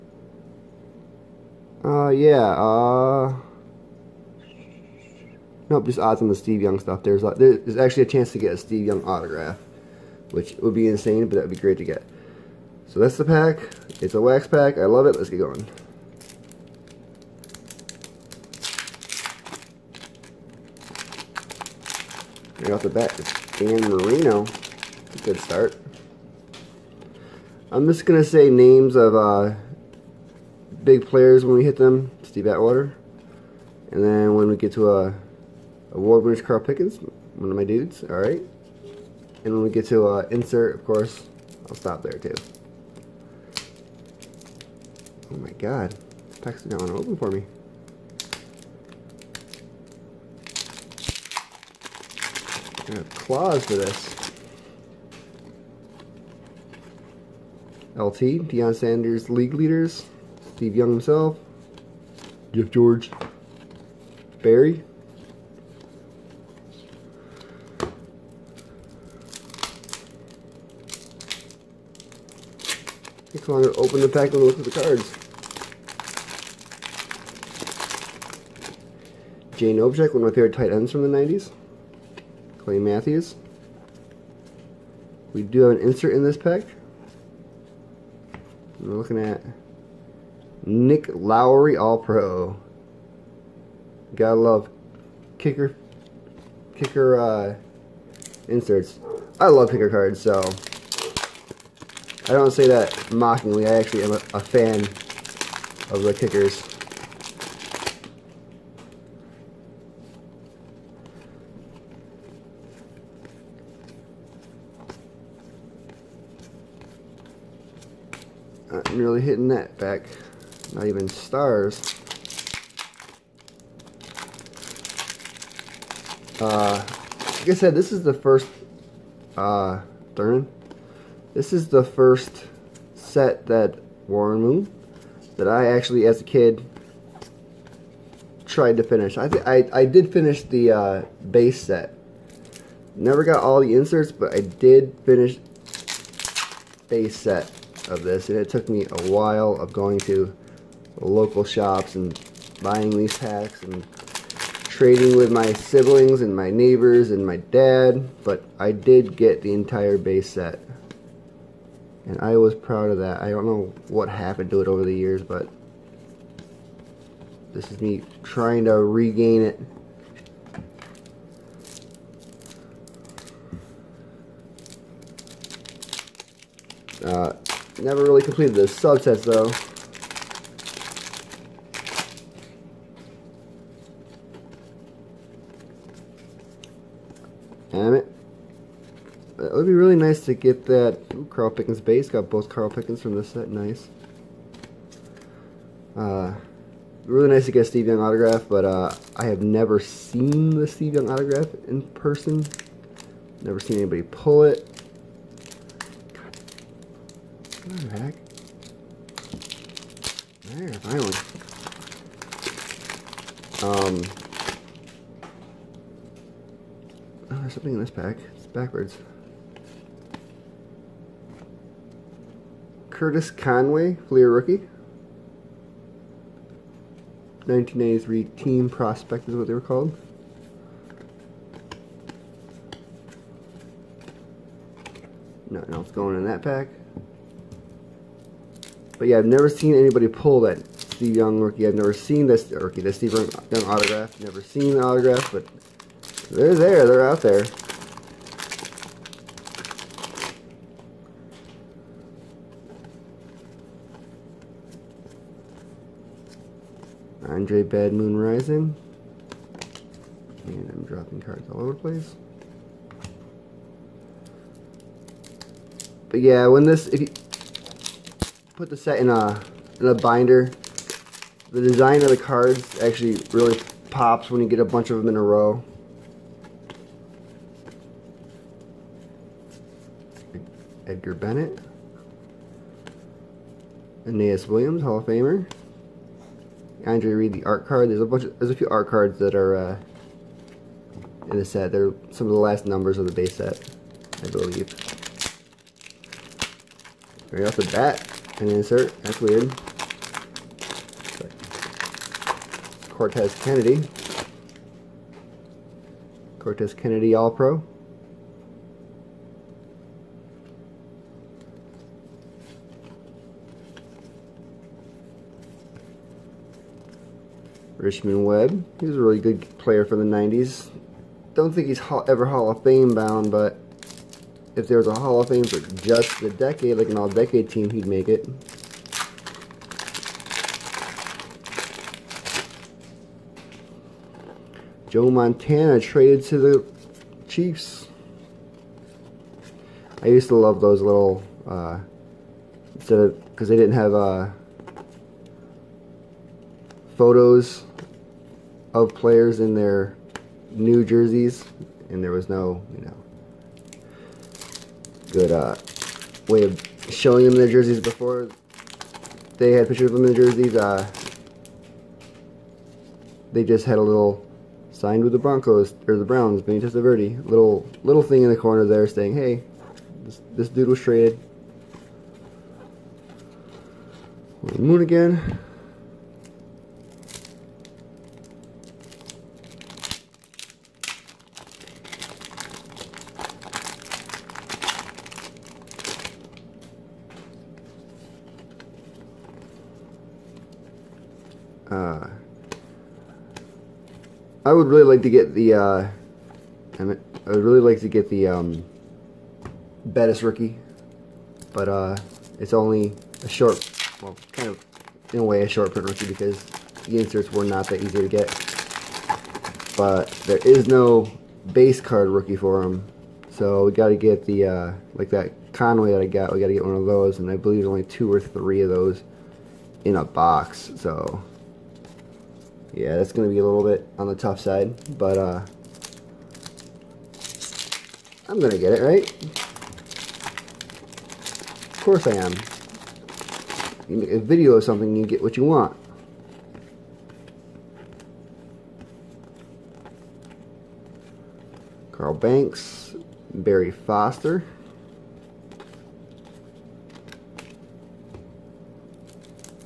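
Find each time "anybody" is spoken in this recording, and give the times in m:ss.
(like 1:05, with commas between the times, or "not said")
3:23, 3:59.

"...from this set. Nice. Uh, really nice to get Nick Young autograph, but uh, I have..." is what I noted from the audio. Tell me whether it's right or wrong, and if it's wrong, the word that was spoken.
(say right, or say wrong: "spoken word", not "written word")
wrong: "Steve", not "Nick".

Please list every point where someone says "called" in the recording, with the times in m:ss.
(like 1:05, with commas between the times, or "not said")
3:49.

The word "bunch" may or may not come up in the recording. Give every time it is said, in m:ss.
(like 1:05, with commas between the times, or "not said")
4:34, 4:48.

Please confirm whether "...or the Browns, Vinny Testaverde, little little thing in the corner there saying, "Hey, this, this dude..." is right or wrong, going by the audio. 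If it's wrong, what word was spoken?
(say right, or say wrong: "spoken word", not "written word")
right.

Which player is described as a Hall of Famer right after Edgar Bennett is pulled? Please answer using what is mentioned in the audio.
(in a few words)
Aeneas Williams.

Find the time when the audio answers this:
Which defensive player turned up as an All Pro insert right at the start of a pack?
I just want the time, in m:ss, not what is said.
5:06.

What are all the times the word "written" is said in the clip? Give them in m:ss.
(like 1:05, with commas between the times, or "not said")
not said.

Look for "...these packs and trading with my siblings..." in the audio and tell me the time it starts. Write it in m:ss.
2:32.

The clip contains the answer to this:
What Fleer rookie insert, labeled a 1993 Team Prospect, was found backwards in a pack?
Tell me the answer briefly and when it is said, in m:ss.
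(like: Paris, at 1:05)
Curtis Conway, at 3:42.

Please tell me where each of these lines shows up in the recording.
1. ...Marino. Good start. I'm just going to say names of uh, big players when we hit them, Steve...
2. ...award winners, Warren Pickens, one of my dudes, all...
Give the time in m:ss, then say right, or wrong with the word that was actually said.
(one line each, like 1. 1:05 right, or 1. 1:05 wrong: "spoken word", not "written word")
1. 0:23 right
2. 0:35 wrong: "Carl", not "Warren".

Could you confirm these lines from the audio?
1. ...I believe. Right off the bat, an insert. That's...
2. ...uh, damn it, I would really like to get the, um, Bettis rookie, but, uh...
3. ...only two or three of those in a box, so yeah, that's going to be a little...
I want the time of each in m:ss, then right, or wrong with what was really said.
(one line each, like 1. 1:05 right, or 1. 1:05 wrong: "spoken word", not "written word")
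1. 4:54 right
2. 6:35 right
3. 6:57 right.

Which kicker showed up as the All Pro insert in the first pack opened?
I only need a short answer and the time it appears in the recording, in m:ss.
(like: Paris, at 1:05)
Nick Lowery, at 1:30.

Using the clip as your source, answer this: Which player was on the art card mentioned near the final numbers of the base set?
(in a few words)
Andre Reed.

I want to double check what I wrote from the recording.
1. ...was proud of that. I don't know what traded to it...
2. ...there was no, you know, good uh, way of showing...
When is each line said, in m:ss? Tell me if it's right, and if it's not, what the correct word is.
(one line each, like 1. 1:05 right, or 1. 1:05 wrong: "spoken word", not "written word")
1. 2:42 wrong: "happened", not "traded"
2. 5:52 right.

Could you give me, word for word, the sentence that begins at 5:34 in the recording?
Joe Montana traded to the Chiefs.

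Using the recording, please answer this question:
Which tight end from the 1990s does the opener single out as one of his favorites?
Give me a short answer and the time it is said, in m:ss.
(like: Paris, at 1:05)
Jay Novacek, at 1:19.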